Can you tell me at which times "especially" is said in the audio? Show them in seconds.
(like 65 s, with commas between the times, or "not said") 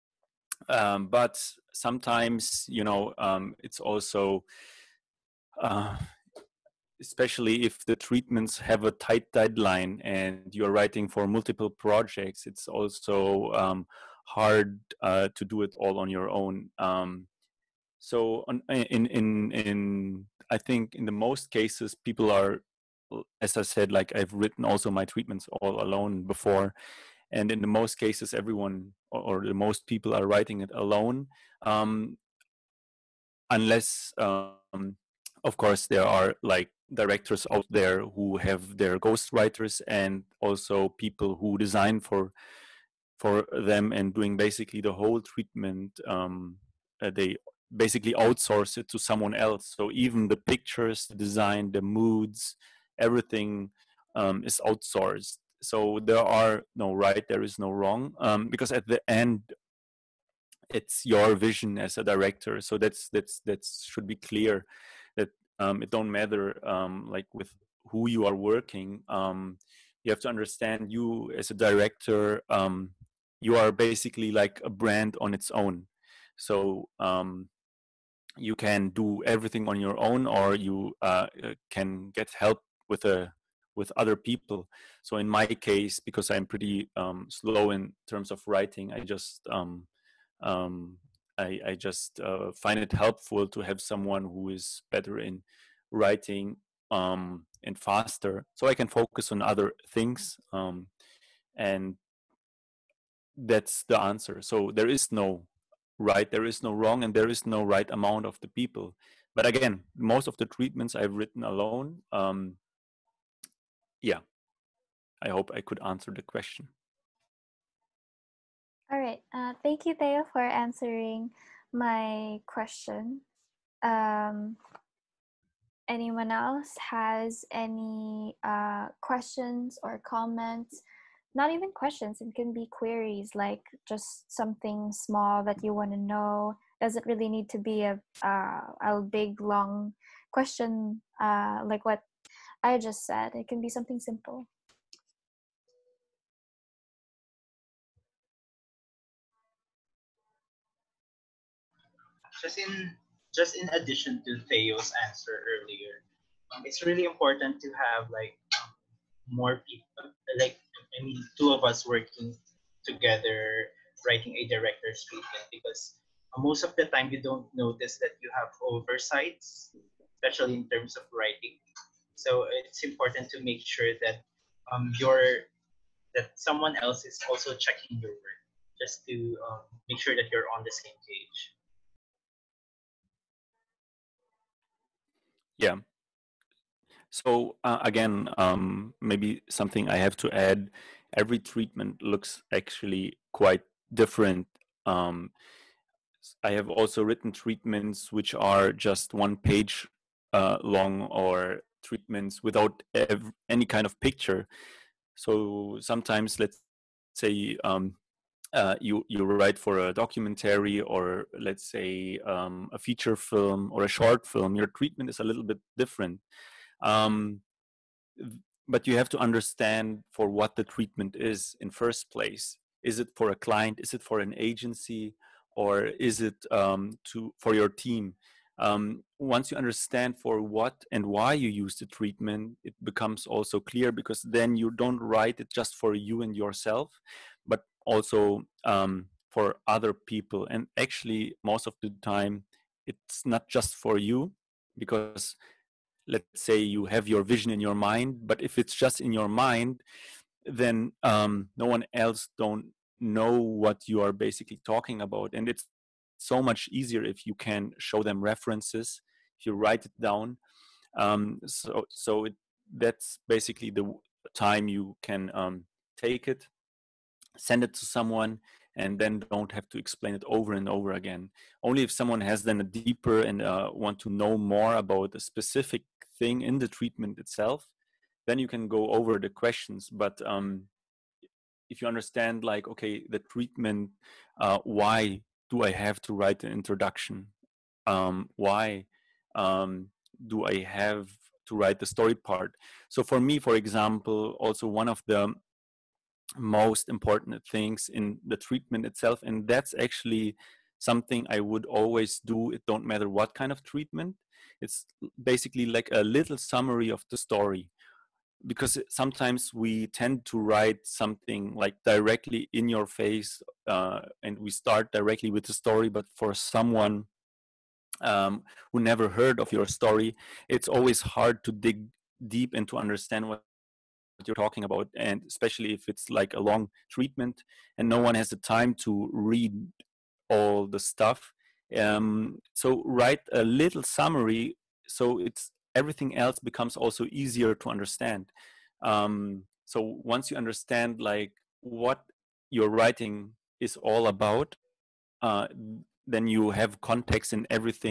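7 s, 170 s, 325 s.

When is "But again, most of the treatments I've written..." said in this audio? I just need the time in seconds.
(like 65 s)
109 s.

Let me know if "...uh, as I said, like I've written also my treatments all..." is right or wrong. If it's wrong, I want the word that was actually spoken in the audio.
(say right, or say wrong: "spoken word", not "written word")
right.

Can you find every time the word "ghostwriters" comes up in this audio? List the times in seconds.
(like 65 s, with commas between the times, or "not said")
38 s.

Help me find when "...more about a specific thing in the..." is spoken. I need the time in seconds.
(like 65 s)
274 s.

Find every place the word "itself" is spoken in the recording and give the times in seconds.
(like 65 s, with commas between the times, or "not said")
277 s, 298 s.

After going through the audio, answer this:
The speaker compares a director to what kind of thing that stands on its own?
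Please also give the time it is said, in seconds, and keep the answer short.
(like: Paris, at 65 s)
a brand, at 74 s.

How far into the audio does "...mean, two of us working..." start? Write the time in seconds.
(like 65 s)
161 s.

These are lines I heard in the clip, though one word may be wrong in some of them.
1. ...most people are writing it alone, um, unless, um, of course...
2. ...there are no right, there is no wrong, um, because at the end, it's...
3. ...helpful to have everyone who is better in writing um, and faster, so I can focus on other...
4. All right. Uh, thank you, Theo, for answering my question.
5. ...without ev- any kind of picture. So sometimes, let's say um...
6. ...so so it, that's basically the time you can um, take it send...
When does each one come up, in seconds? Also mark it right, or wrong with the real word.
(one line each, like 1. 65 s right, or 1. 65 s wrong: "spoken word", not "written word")
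1. 29 s right
2. 56 s right
3. 92 s wrong: "someone", not "everyone"
4. 118 s right
5. 202 s right
6. 261 s right.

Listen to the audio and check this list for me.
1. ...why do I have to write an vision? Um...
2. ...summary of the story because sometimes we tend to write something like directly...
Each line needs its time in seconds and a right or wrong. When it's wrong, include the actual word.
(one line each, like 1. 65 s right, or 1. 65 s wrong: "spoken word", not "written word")
1. 284 s wrong: "introduction", not "vision"
2. 306 s right.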